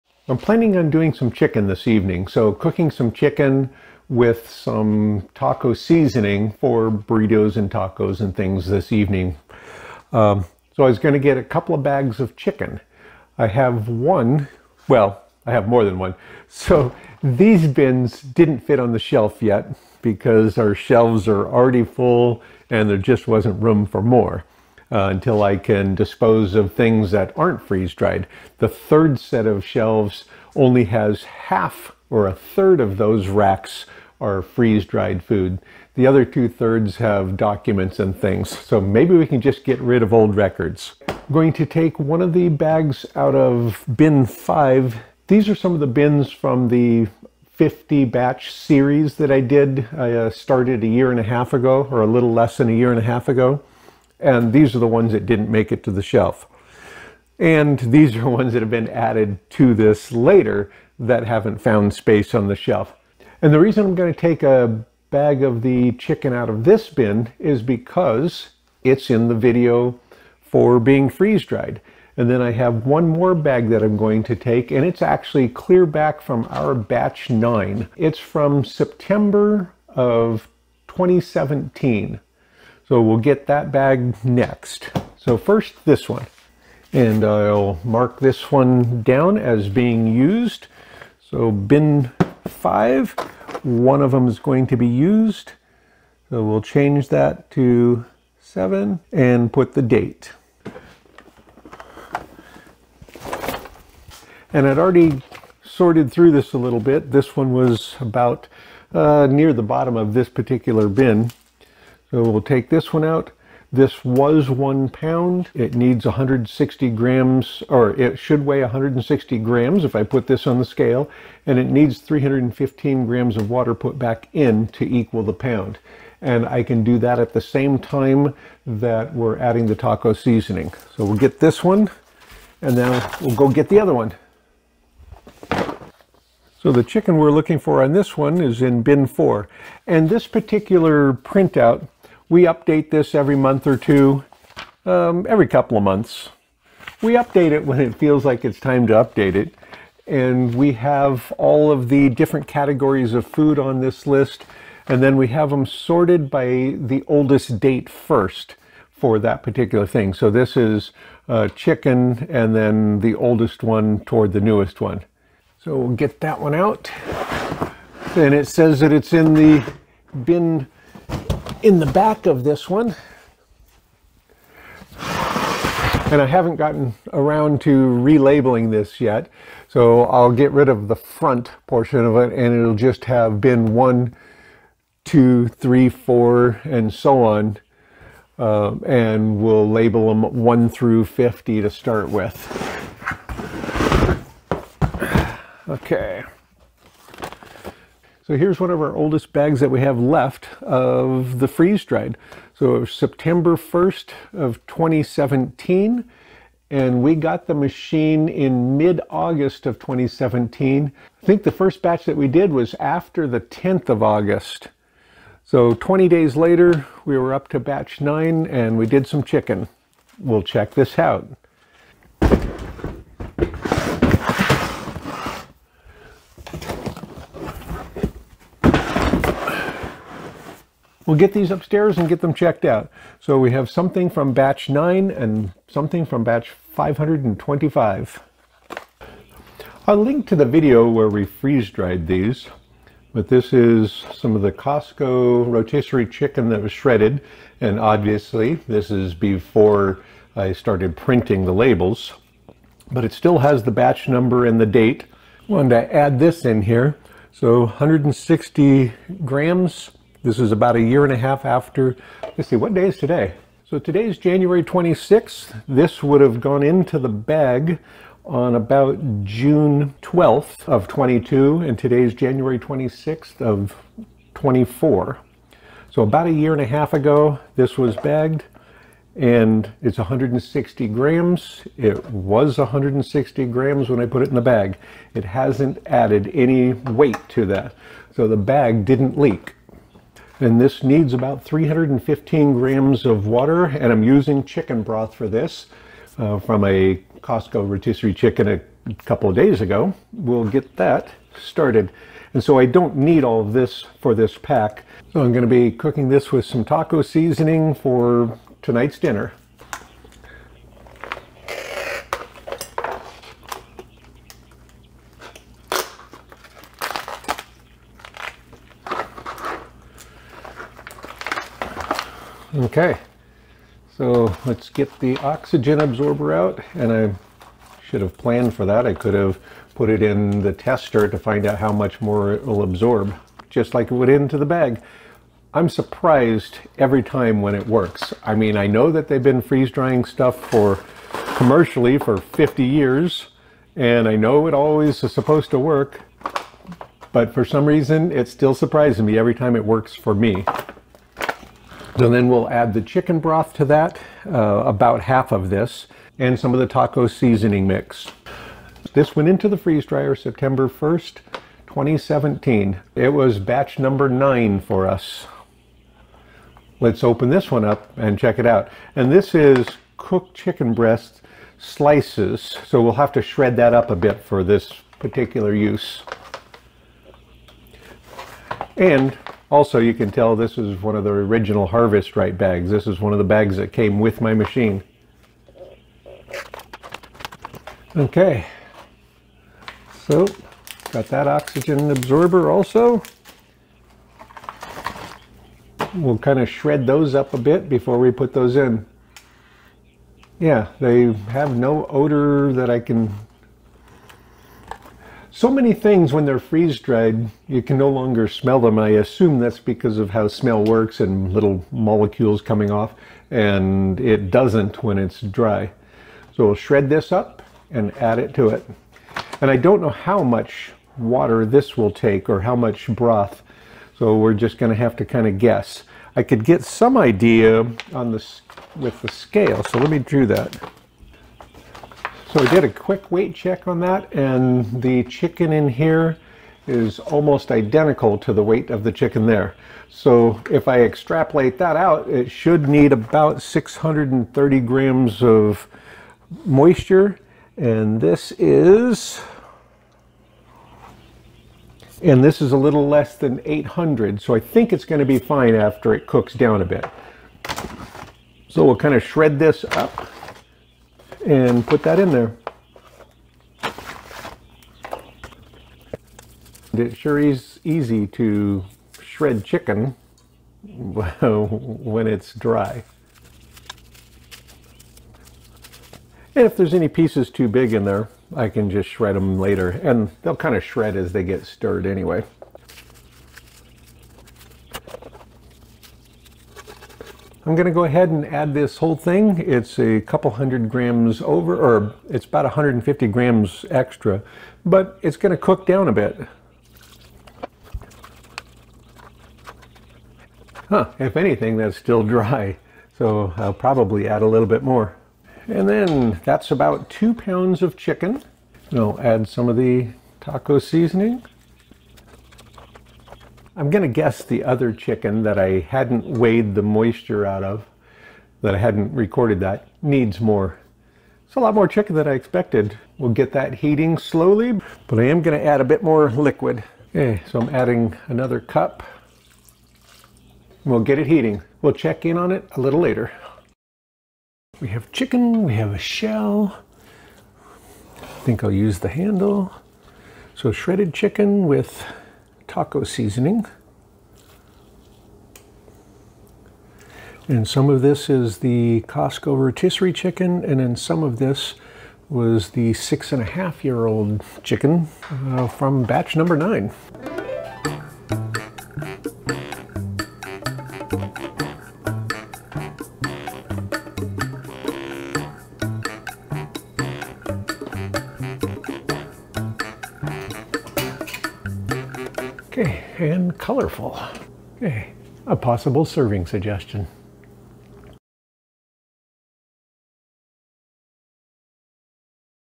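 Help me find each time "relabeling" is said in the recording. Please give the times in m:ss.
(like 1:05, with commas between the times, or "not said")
2:57.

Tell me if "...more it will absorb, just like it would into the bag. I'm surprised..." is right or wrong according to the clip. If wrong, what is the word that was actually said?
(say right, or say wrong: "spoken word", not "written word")
right.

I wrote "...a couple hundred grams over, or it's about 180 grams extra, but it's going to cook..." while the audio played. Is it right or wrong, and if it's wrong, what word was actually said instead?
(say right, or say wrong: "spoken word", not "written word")
wrong: "150", not "180".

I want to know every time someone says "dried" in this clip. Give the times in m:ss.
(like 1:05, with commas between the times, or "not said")
0:27, 0:34, 1:11, 3:21, 4:01, 6:46.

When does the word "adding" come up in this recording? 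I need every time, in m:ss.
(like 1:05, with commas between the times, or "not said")
2:09, 8:47.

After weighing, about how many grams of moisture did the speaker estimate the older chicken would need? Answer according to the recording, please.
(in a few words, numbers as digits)
630 grams.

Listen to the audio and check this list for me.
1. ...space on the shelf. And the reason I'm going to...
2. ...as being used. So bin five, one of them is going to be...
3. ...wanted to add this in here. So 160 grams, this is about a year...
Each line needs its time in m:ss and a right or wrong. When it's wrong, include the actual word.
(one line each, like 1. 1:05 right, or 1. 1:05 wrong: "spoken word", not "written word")
1. 1:01 right
2. 1:29 right
3. 4:15 right.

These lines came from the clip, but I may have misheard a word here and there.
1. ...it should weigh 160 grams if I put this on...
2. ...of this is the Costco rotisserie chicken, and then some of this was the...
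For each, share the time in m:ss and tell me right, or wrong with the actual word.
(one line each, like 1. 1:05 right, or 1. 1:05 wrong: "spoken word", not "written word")
1. 1:57 right
2. 9:07 right.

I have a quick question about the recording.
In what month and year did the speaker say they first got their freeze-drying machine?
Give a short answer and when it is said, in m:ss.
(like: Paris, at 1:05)
August 2017, at 3:28.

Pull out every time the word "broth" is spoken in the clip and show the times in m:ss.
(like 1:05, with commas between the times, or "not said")
4:54, 5:53, 7:02.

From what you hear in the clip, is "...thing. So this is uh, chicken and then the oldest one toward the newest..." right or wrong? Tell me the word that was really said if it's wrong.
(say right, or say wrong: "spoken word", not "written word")
right.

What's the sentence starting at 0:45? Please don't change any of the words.
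These are some of the bins from the 50 batch series that I did.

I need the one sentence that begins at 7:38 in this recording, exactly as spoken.
So we'll kind of shred this up and put that in there.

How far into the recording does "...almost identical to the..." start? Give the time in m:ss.
7:16.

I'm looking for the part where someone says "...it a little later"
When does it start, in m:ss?
8:52.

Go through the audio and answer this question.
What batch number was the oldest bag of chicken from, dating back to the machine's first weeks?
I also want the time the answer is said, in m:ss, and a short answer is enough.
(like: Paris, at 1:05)
9, at 1:16.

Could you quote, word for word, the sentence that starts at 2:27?
We update it when it feels like it's time to update it.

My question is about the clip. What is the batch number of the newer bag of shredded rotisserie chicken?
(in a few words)
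525.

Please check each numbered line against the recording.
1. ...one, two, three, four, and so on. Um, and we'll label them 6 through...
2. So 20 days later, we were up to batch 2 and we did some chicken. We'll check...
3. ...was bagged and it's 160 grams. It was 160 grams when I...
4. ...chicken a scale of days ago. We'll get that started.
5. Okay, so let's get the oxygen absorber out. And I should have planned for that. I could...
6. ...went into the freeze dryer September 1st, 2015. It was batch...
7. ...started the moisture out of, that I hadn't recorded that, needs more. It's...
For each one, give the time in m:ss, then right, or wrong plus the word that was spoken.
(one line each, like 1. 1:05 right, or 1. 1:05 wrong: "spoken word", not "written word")
1. 3:03 wrong: "1", not "6"
2. 3:35 wrong: "9", not "2"
3. 4:37 right
4. 4:58 wrong: "couple", not "scale"
5. 5:22 right
6. 5:59 wrong: "2017", not "2015"
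7. 8:36 wrong: "weighed", not "started".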